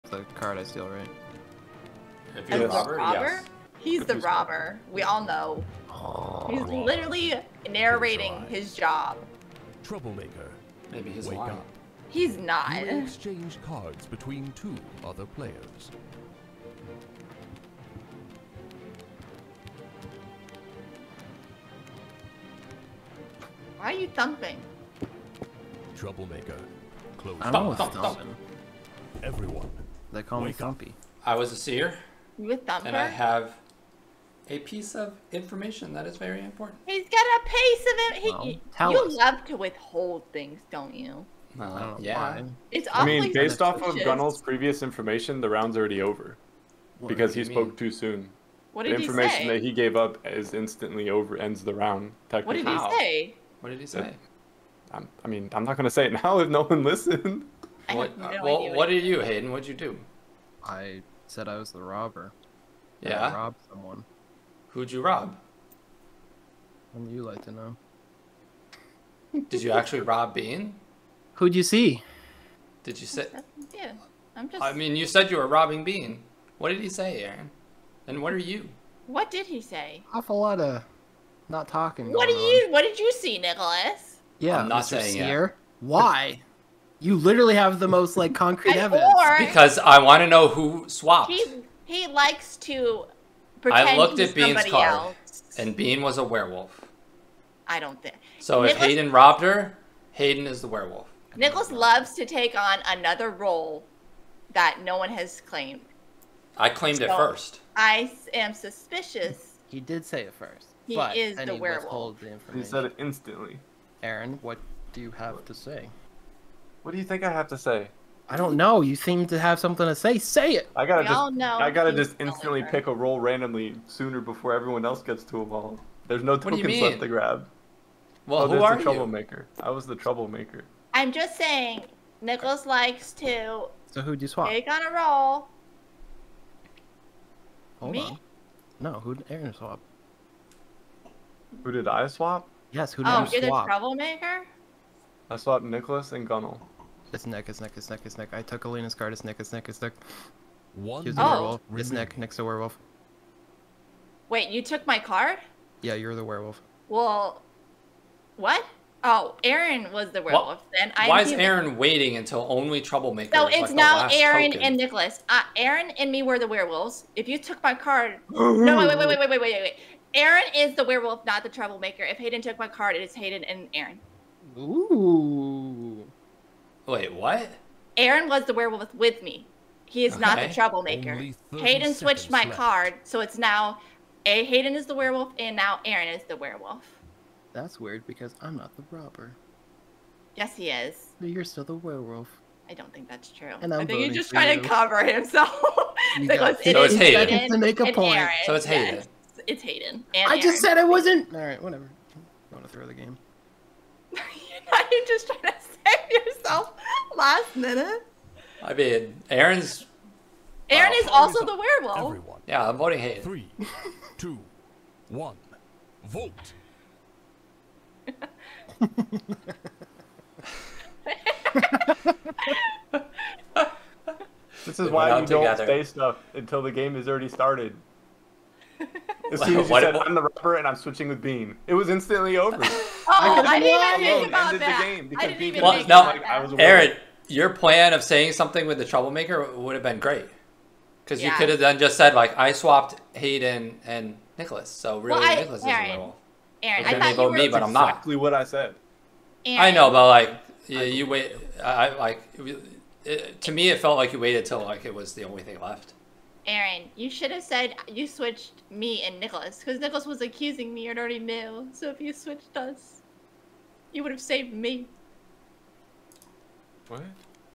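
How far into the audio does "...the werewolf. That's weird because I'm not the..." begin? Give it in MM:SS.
03:06.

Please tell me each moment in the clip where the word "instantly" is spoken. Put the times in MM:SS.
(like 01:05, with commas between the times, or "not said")
00:50, 01:52, 02:02, 03:51.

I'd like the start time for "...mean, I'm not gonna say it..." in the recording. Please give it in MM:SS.
00:55.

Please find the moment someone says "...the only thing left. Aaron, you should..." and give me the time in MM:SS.
04:15.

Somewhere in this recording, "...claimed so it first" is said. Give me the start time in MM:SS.
01:46.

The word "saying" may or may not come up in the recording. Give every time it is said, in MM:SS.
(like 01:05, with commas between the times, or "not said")
01:25, 02:11, 03:58.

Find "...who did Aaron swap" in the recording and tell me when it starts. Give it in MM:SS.
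02:18.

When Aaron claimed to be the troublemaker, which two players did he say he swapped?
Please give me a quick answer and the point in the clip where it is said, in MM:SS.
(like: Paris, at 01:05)
Nicholas and Gunnel, at 02:25.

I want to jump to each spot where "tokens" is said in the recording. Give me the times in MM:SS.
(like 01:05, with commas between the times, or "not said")
02:06, 02:44.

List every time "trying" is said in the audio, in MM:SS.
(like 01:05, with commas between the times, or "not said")
03:14, 03:25.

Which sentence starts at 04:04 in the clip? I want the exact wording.
So really, well, I, Nicholas Aaron, is the role.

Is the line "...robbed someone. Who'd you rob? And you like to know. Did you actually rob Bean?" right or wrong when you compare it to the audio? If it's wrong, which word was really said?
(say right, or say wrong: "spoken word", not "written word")
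right.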